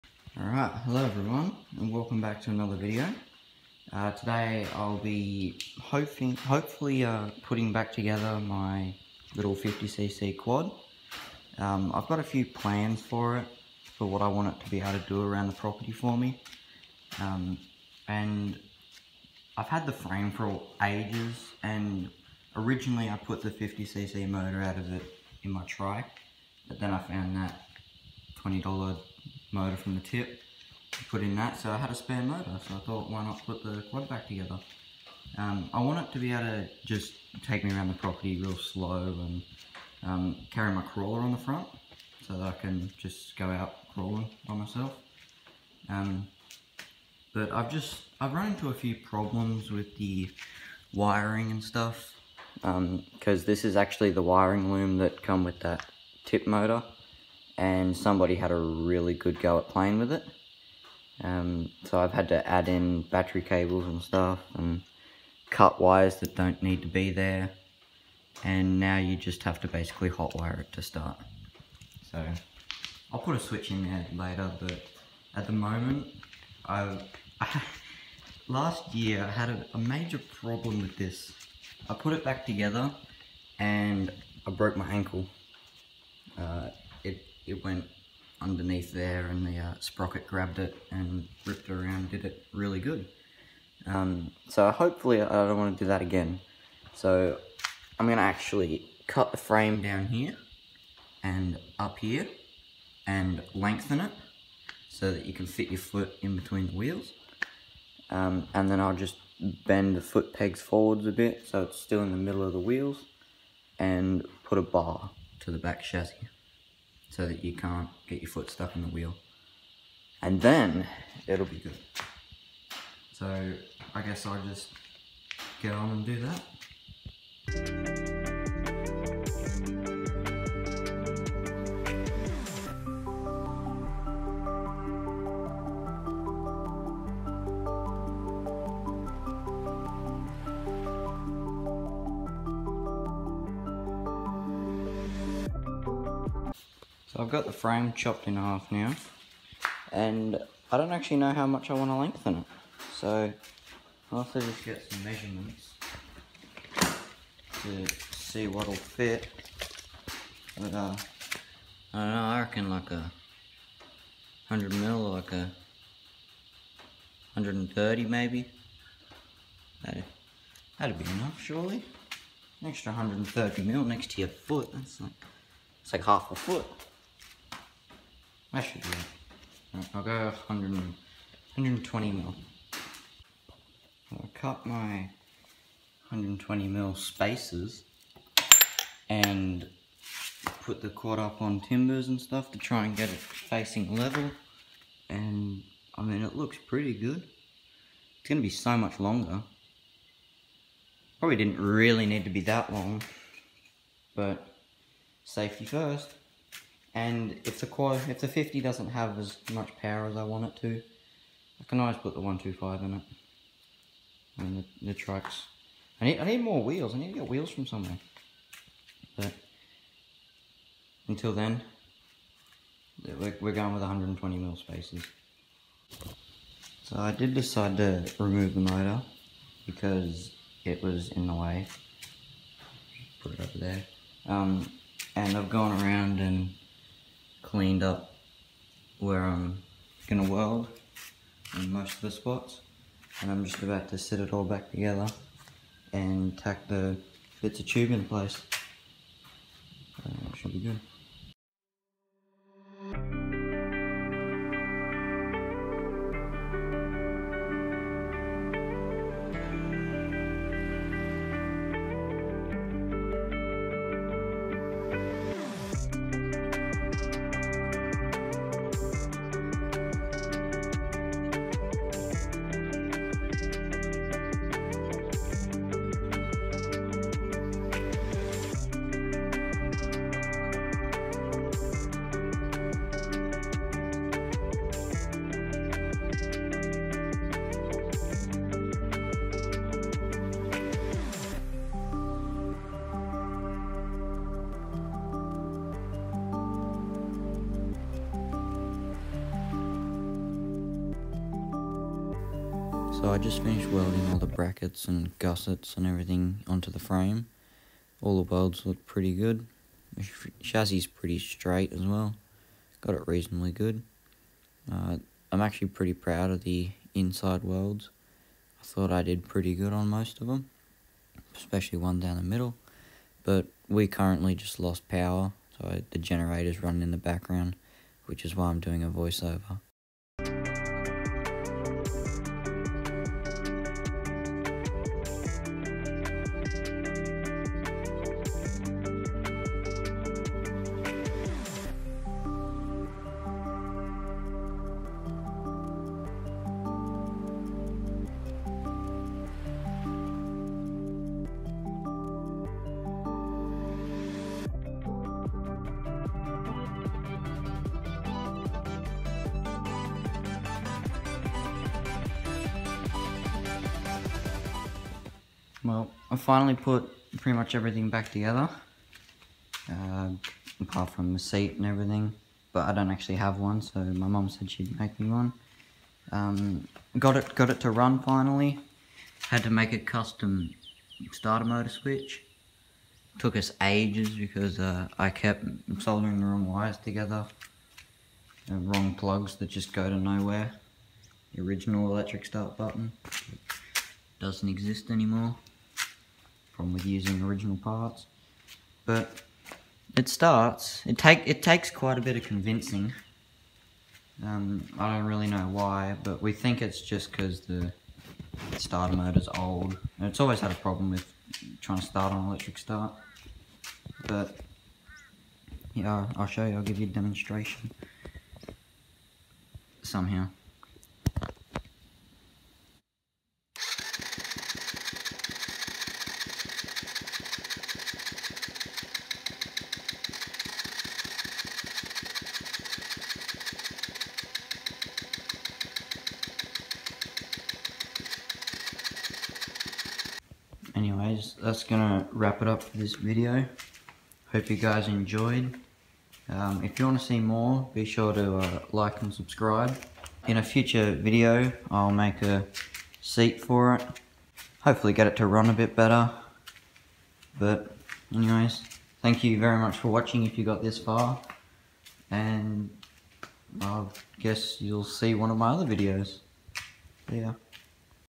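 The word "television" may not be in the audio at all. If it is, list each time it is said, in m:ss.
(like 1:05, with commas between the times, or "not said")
not said.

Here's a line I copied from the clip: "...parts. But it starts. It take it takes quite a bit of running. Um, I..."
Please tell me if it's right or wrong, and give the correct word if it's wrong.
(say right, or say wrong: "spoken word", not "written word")
wrong: "convincing", not "running".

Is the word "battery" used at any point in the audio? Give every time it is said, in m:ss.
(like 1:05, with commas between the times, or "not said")
1:03.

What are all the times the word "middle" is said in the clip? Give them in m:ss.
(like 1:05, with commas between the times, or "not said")
1:52, 5:22.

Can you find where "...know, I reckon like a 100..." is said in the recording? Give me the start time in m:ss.
2:42.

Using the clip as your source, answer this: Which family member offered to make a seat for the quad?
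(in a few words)
mom.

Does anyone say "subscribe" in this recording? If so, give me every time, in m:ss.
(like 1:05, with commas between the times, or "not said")
7:29.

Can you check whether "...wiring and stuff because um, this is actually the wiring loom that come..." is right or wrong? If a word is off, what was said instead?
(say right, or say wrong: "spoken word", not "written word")
right.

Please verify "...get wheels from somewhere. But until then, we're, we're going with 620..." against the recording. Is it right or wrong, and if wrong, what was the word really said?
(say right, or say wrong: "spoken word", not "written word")
wrong: "120", not "620".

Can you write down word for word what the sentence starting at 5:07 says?
All the welds look pretty good.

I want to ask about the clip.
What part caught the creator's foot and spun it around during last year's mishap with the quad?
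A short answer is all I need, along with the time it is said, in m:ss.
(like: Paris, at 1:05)
sprocket, at 1:29.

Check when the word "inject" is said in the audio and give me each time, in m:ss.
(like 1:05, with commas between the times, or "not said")
not said.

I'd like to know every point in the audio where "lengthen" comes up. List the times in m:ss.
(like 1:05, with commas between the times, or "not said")
1:43, 2:31.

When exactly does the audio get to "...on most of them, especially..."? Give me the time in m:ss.
5:19.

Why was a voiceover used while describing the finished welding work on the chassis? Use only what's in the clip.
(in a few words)
lost power.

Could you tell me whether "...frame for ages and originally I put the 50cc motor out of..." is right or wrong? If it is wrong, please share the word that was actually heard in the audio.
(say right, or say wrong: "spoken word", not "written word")
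right.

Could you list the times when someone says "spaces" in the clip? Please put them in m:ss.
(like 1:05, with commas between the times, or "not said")
3:06, 3:44.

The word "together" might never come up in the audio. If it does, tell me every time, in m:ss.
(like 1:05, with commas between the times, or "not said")
0:07, 0:34, 1:22, 4:04, 6:08, 6:26.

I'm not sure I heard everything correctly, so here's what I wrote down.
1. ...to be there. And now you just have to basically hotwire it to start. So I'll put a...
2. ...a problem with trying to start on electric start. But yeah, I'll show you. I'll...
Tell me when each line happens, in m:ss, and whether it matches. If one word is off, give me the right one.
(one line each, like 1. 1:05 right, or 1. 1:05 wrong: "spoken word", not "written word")
1. 1:06 right
2. 6:50 right.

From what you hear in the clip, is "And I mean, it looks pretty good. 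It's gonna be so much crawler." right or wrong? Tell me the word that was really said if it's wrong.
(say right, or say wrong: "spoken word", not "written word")
wrong: "longer", not "crawler".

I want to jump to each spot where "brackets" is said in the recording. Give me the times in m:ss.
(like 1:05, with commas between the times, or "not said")
5:04.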